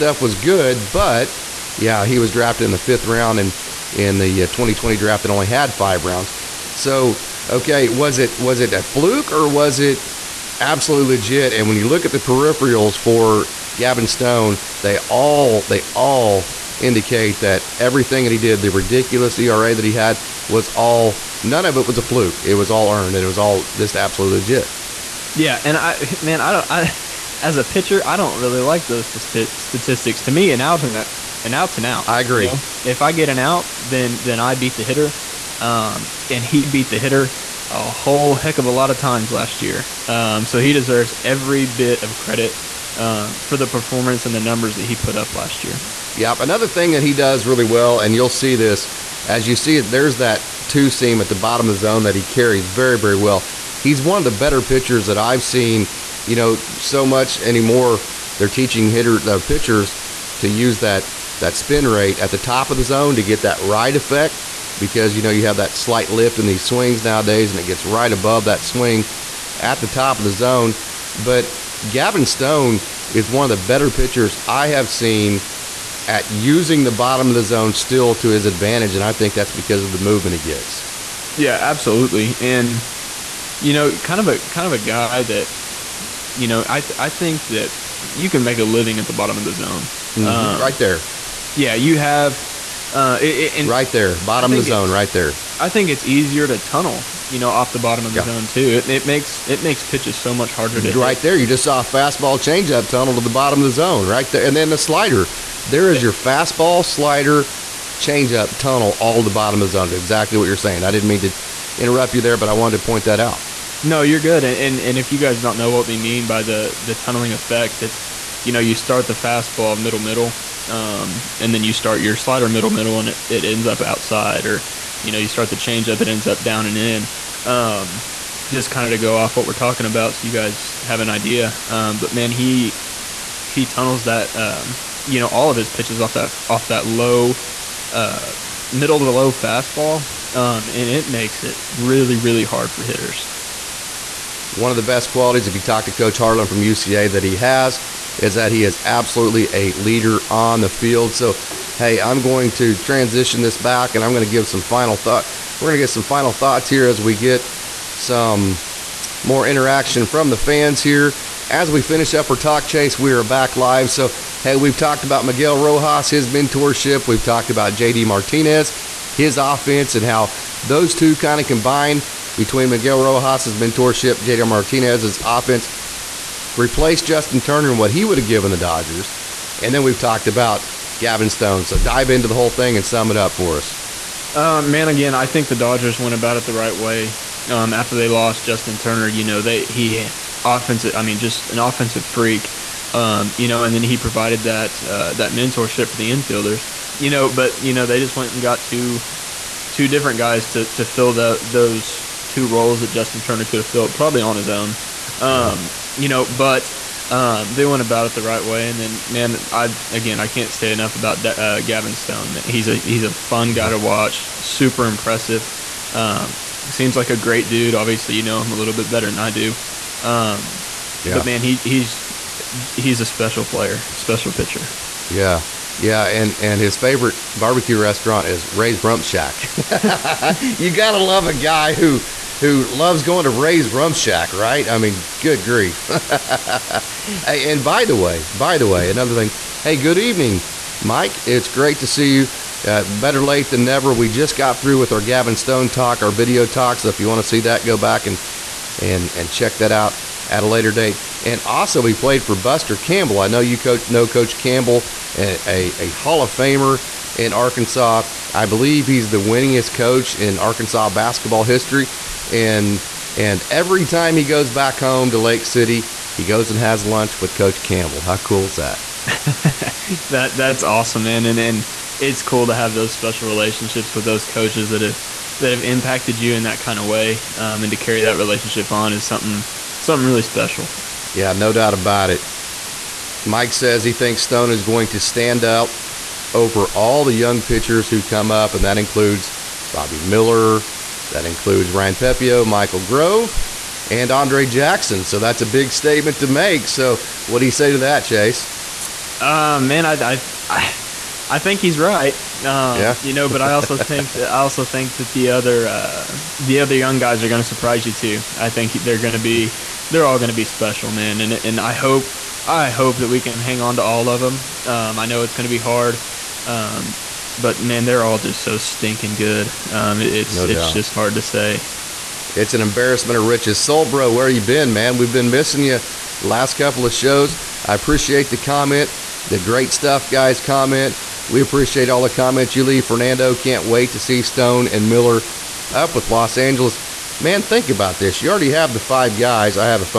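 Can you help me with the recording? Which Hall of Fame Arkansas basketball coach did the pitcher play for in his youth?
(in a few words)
Buster Campbell.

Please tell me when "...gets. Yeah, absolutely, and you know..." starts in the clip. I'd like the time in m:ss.
1:20.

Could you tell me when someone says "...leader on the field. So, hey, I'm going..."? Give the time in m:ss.
2:29.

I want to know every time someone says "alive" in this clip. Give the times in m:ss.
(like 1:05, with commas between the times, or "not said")
not said.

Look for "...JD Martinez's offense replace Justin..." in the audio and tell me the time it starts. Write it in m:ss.
2:54.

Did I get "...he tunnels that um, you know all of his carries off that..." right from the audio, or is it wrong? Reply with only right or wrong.
wrong.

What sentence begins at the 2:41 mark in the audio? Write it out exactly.
As we finish up our talk chase, we are back live.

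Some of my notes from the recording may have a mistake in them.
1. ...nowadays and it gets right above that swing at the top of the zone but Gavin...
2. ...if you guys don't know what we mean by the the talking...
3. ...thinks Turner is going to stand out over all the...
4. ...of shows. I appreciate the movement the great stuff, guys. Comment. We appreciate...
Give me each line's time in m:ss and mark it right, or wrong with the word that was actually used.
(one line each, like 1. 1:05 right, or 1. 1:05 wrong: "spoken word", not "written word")
1. 1:07 right
2. 1:54 wrong: "tunneling", not "talking"
3. 4:43 wrong: "Stone", not "Turner"
4. 5:26 wrong: "comment", not "movement".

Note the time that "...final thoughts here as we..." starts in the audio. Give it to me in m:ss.
2:36.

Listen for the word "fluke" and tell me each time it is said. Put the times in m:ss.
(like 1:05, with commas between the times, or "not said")
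0:08, 0:22.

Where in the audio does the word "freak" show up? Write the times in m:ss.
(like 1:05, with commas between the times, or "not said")
3:12.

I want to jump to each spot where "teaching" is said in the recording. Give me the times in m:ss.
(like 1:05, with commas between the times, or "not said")
0:58.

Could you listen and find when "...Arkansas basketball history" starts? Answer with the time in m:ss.
4:20.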